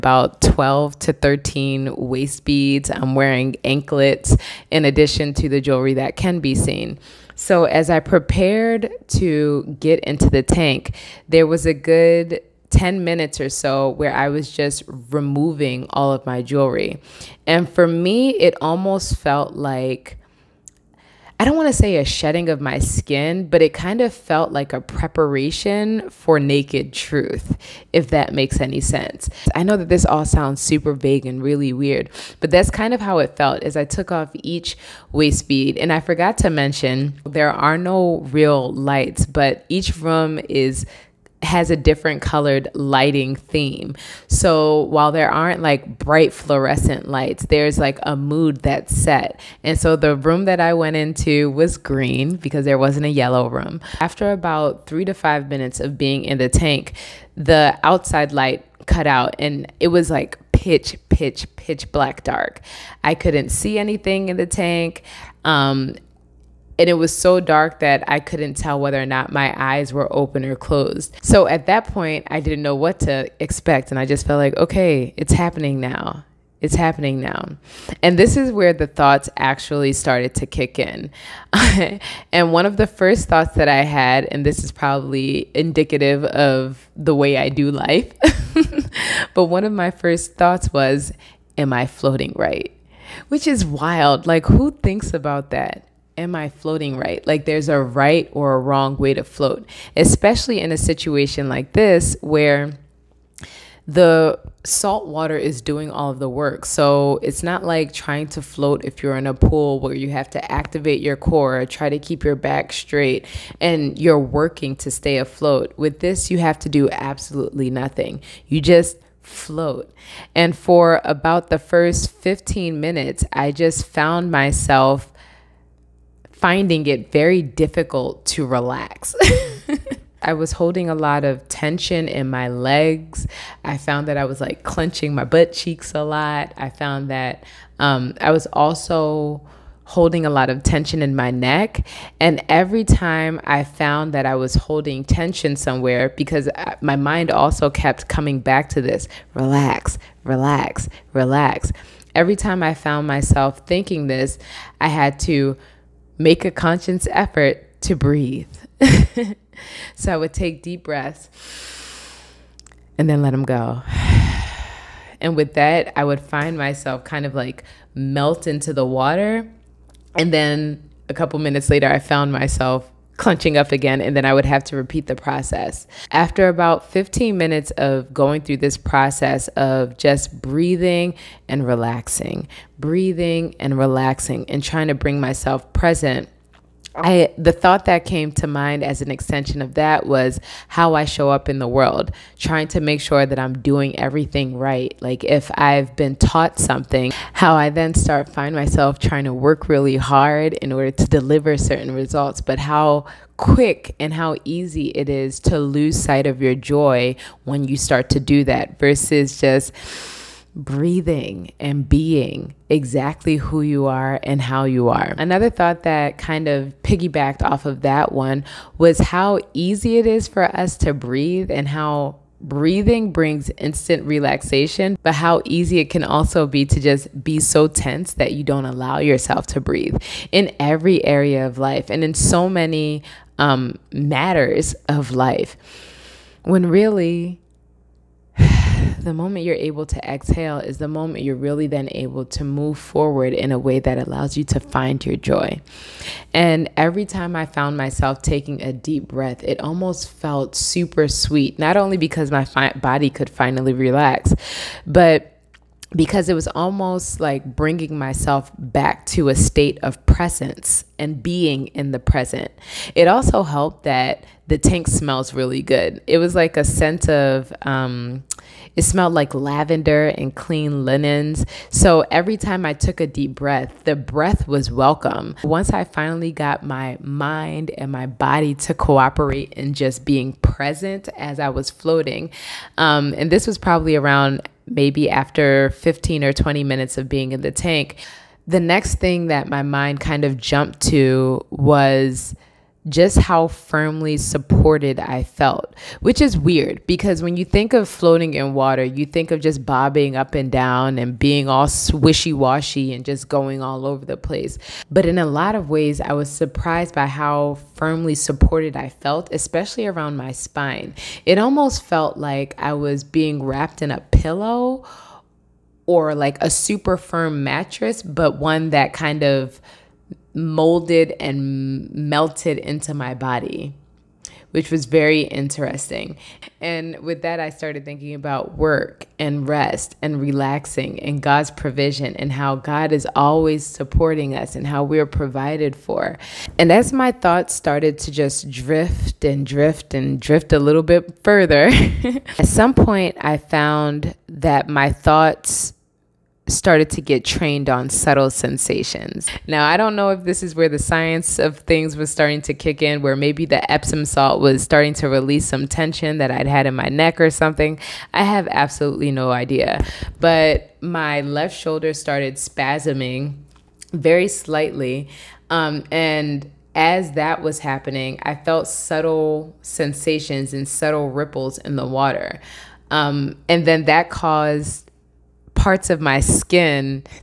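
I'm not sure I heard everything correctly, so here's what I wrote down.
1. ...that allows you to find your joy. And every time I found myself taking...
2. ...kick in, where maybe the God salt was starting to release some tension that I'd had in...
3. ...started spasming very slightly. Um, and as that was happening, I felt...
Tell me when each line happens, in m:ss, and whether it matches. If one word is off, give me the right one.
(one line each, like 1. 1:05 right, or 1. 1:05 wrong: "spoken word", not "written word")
1. 4:03 right
2. 5:52 wrong: "Epsom", not "God"
3. 6:01 right.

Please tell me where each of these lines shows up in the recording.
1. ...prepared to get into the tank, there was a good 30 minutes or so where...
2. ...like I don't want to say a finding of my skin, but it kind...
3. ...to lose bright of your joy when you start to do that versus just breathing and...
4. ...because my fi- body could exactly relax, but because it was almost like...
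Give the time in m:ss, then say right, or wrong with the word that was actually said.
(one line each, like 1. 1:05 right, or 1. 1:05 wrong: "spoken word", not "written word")
1. 0:07 wrong: "10", not "30"
2. 0:19 wrong: "shedding", not "finding"
3. 3:25 wrong: "sight", not "bright"
4. 4:11 wrong: "finally", not "exactly".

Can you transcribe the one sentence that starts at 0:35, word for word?
And I forgot to mention there are no real lights, but each room is has a different colored lighting theme.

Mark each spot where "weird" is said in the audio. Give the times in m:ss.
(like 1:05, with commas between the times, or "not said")
0:31, 4:56.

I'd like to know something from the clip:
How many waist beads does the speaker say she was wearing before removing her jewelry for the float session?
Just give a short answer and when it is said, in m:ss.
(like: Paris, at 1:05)
12 to 13, at 0:00.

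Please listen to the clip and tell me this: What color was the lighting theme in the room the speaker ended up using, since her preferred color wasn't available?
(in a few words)
Green.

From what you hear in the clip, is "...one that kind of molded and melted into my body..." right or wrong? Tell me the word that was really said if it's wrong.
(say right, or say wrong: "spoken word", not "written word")
right.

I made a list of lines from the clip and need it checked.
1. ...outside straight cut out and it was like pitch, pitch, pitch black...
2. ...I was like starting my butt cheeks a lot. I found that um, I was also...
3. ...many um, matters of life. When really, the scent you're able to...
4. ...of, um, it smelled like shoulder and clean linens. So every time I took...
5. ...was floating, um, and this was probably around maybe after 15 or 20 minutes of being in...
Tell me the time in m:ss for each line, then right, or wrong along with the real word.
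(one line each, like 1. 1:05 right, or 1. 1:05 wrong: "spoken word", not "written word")
1. 0:57 wrong: "light", not "straight"
2. 2:14 wrong: "clenching", not "starting"
3. 3:52 wrong: "moment", not "scent"
4. 4:27 wrong: "lavender", not "shoulder"
5. 4:41 right.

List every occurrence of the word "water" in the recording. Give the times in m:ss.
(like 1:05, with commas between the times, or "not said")
1:45, 2:48, 4:58, 6:11.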